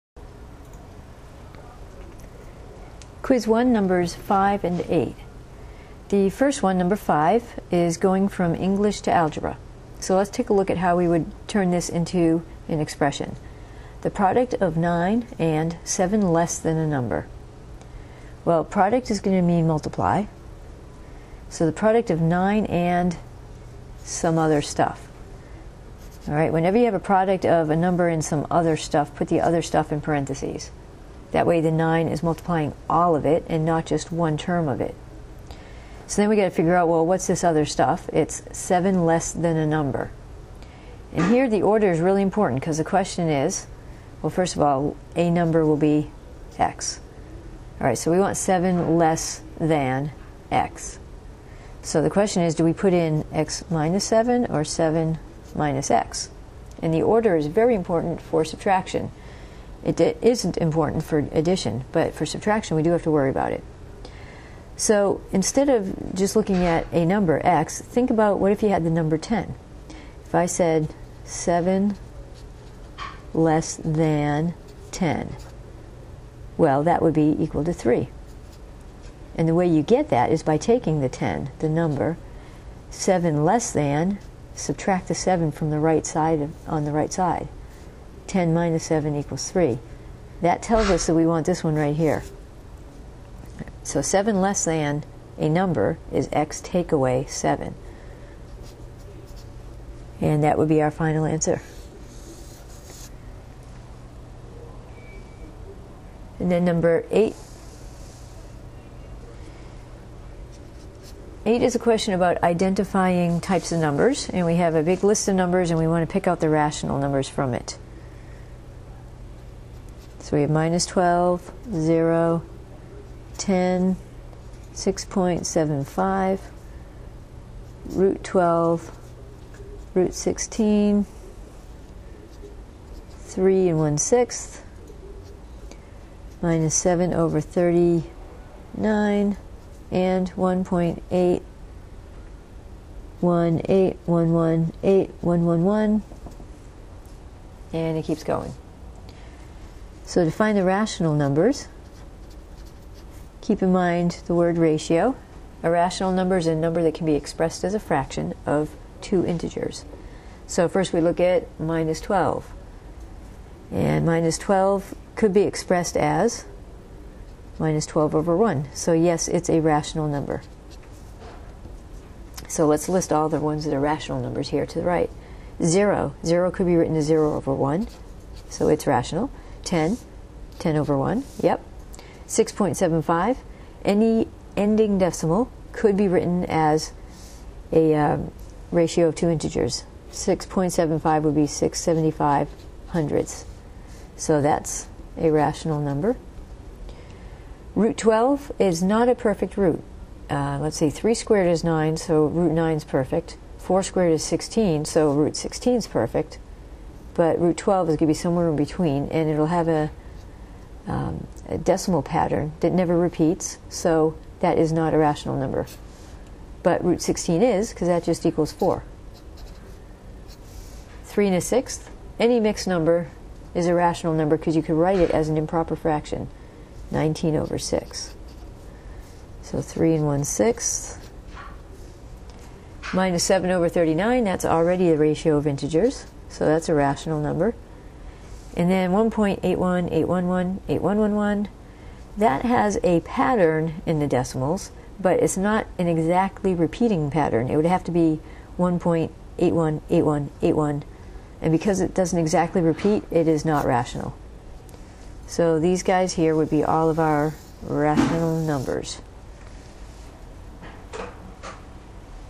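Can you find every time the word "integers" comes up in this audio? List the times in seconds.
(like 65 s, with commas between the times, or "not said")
159 s, 189 s, 235 s.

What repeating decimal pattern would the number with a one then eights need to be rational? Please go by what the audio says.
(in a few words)
1.818181.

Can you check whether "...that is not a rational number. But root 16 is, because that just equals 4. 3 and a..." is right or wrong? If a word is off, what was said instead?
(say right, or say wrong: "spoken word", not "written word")
right.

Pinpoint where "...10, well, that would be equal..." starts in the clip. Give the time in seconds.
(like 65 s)
74 s.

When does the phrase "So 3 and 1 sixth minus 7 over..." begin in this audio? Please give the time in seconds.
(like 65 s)
229 s.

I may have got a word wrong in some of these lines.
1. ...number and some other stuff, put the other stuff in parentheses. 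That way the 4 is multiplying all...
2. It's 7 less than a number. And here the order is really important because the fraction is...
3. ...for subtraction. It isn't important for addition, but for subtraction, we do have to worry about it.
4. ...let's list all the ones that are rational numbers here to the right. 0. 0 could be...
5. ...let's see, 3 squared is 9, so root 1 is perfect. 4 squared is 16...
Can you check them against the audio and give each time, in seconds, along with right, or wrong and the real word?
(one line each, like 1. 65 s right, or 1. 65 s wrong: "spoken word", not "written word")
1. 27 s wrong: "9", not "4"
2. 38 s wrong: "question", not "fraction"
3. 58 s right
4. 172 s right
5. 200 s wrong: "9", not "1".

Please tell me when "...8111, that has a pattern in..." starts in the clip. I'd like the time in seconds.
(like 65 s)
240 s.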